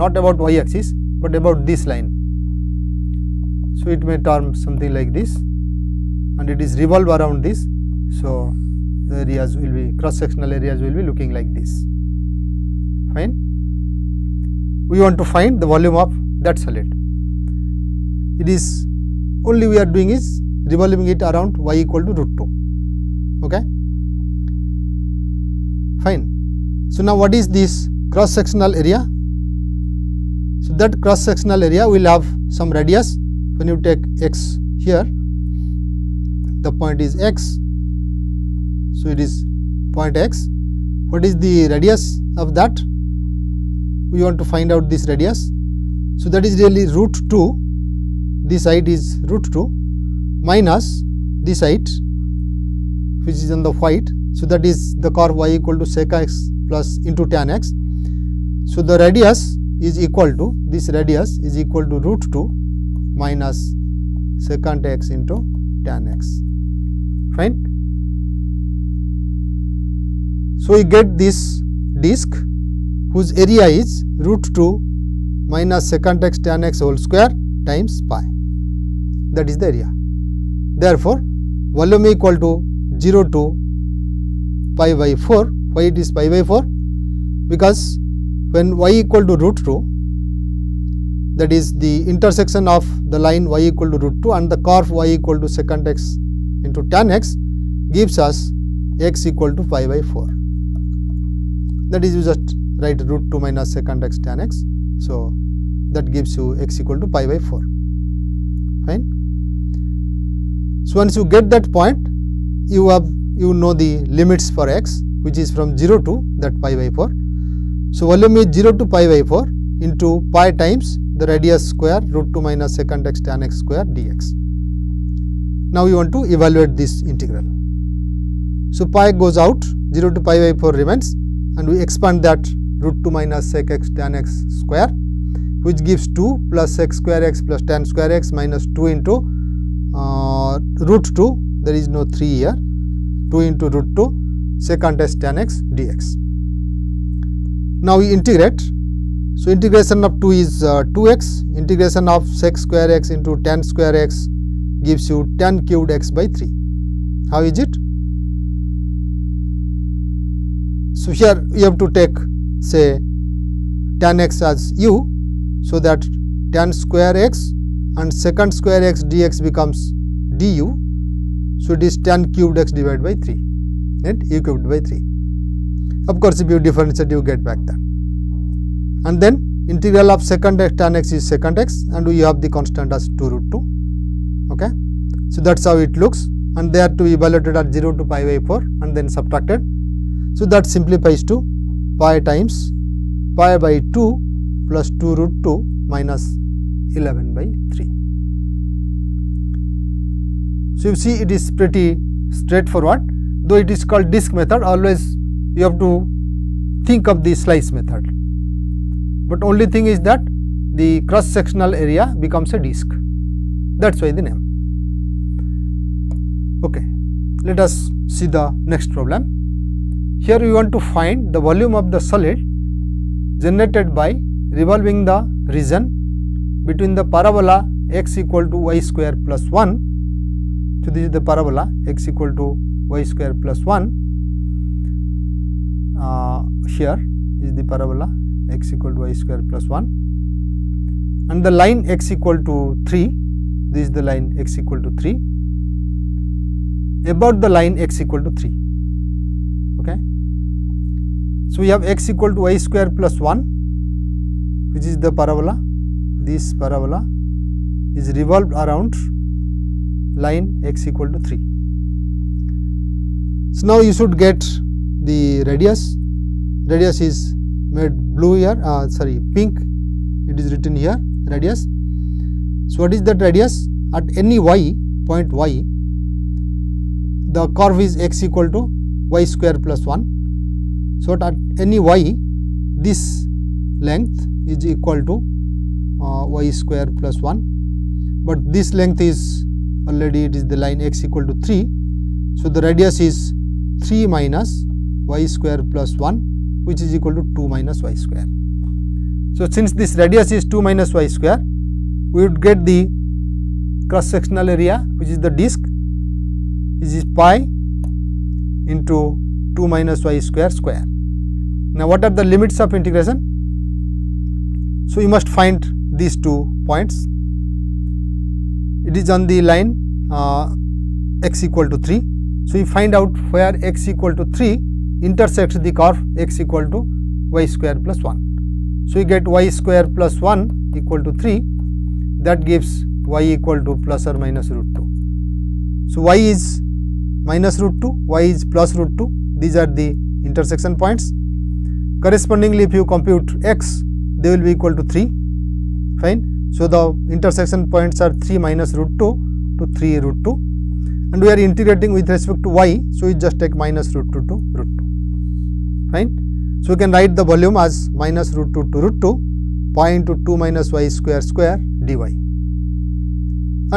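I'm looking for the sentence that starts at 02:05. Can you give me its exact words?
Now, you want to evaluate this integral.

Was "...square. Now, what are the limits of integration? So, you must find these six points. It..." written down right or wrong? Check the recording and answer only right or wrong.
wrong.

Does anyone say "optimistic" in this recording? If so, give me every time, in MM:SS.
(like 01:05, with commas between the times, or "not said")
not said.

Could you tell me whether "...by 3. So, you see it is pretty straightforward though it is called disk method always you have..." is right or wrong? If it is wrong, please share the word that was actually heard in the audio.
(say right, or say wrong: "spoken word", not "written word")
right.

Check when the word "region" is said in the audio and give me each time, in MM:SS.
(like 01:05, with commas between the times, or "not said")
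03:45.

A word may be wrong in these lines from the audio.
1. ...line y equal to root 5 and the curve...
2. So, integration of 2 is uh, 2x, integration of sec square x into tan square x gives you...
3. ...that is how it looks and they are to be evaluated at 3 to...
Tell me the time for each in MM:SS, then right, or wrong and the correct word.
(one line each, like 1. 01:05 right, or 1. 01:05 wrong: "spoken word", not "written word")
1. 01:33 wrong: "2", not "5"
2. 02:29 right
3. 03:05 wrong: "0", not "3".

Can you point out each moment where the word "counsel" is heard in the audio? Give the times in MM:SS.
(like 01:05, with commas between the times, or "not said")
not said.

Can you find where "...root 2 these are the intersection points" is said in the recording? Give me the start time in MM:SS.
05:38.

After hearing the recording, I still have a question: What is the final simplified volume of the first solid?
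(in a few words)
pi(pi/2 + 2 root 2 - 11/3).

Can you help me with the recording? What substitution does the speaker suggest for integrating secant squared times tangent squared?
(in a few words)
tan x as u.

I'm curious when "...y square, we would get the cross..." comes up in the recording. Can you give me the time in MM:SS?
05:00.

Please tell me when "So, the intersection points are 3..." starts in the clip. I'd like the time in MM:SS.
05:46.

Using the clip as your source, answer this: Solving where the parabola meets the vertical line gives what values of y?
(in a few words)
plus or minus root 2.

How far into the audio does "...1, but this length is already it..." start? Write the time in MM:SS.
04:47.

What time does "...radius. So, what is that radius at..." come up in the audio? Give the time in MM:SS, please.
04:31.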